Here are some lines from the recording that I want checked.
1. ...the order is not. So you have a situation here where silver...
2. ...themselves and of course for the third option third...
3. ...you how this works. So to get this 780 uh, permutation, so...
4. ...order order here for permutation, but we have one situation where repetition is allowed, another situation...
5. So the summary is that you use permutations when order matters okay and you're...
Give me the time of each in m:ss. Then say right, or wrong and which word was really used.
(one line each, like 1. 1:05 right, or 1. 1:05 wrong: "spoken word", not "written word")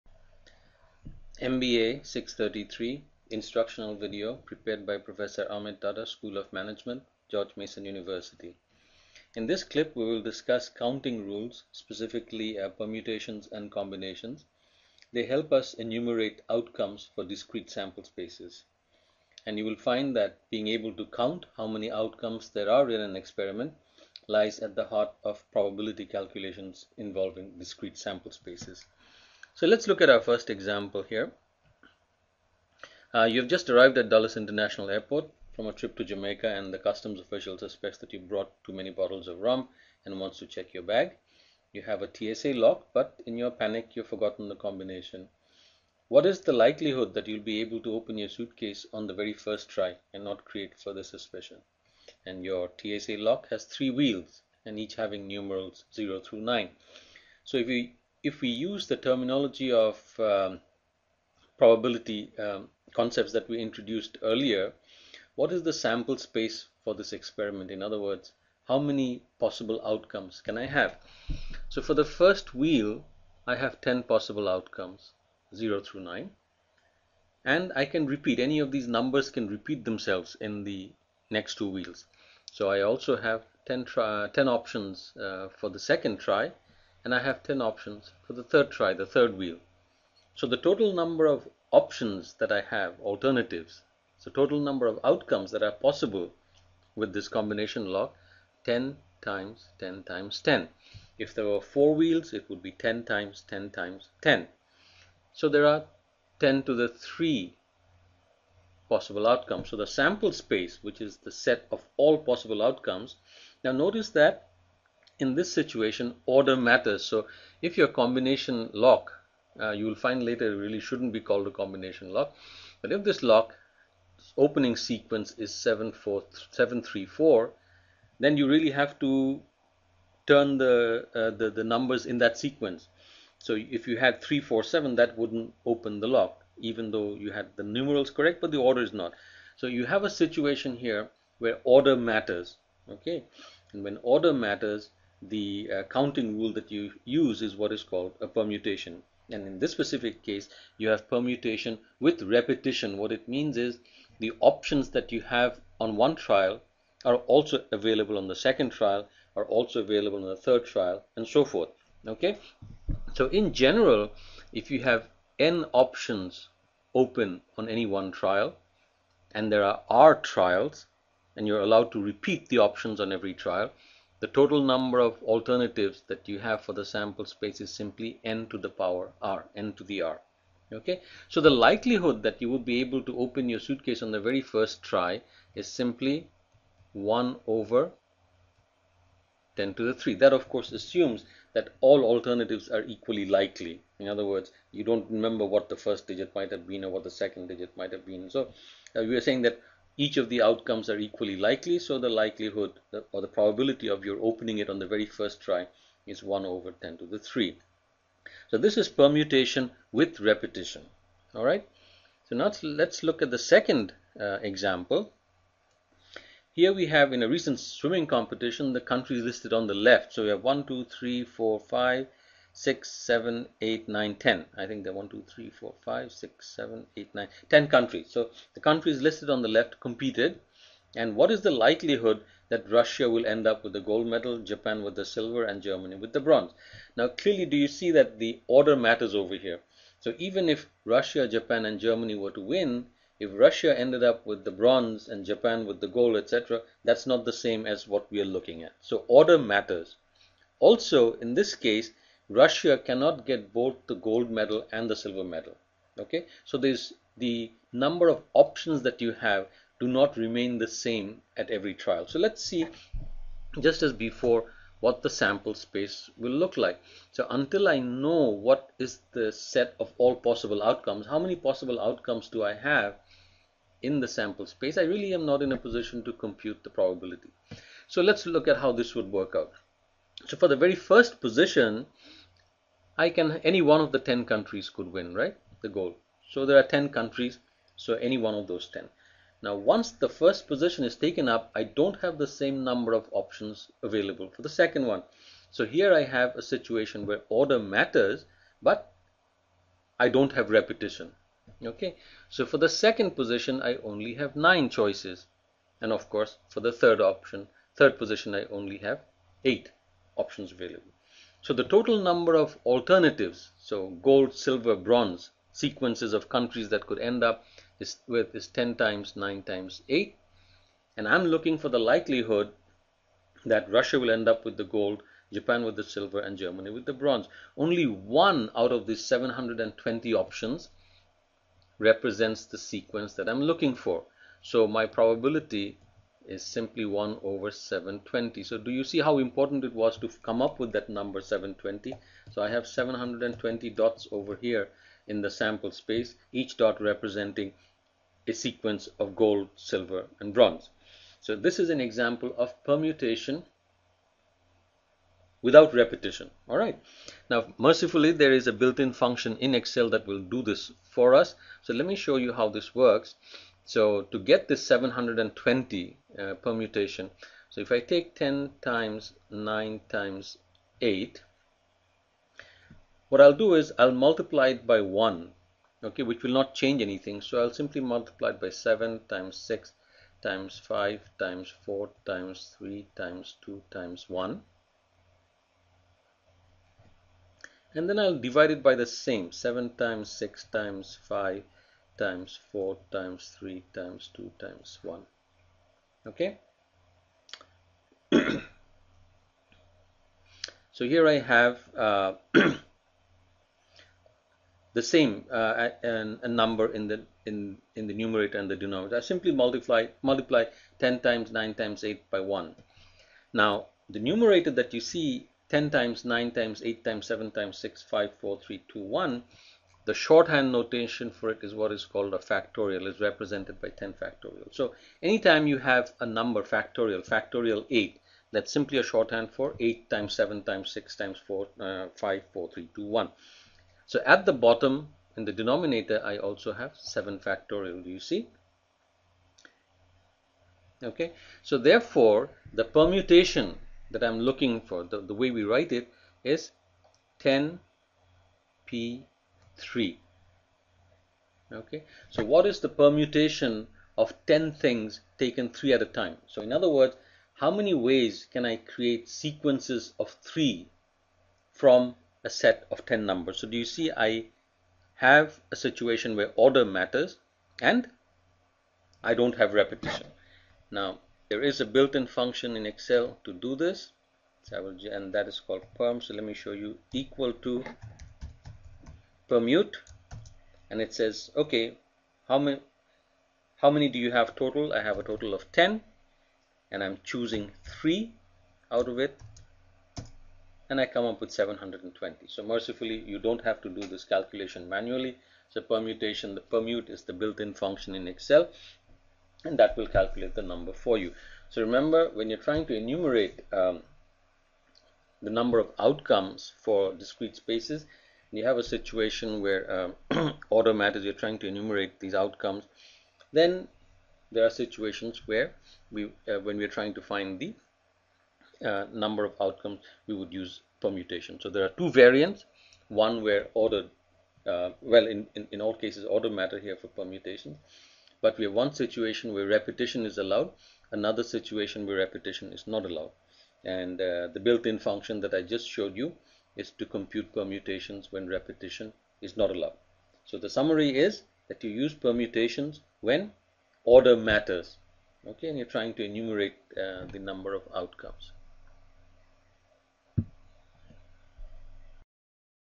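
1. 2:18 wrong: "order", not "silver"
2. 5:04 wrong: "choices", not "themselves"
3. 6:02 wrong: "720", not "780"
4. 8:46 wrong: "matter", not "order"
5. 9:00 right.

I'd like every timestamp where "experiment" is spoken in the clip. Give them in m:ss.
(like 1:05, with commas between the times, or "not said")
0:23, 1:07.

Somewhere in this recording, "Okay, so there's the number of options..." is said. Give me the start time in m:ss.
4:15.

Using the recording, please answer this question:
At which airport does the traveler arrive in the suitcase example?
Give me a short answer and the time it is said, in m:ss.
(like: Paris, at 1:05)
Dulles International Airport, at 0:34.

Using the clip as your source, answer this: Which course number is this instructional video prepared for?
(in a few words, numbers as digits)
MBA 633.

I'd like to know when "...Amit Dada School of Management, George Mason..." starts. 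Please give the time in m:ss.
0:05.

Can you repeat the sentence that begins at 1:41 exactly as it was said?
If there were four wheels, it would be 10 times 10 times 10.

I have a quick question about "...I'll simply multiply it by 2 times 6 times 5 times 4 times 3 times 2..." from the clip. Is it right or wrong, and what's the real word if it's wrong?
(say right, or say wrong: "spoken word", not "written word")
wrong: "7", not "2".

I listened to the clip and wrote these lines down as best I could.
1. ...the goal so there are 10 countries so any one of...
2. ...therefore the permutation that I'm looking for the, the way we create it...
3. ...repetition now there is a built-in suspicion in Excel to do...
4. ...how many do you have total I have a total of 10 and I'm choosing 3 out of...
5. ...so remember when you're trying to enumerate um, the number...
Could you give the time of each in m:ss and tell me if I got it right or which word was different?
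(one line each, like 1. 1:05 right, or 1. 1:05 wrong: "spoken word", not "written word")
1. 4:45 right
2. 7:21 wrong: "write", not "create"
3. 7:49 wrong: "function", not "suspicion"
4. 8:03 right
5. 8:21 right.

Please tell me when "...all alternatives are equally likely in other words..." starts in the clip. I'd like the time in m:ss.
3:11.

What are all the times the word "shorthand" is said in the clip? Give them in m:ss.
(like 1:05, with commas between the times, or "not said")
6:59, 7:08.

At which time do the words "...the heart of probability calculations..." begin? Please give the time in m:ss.
0:24.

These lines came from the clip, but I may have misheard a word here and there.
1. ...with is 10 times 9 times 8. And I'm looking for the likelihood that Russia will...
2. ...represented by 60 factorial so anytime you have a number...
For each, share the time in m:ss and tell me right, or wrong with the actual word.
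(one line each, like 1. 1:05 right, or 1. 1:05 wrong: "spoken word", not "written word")
1. 5:18 right
2. 7:02 wrong: "10", not "60".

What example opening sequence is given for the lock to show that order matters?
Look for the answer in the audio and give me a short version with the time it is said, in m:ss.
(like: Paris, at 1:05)
734, at 2:05.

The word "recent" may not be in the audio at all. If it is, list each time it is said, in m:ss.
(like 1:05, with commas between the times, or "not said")
3:37.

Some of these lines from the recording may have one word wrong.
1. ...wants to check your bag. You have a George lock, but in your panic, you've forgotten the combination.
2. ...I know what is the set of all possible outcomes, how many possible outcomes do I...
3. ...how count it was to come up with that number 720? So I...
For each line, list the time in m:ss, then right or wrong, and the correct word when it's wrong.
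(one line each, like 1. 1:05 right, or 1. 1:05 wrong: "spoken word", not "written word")
1. 0:40 wrong: "TSA", not "George"
2. 4:27 right
3. 5:39 wrong: "important", not "count".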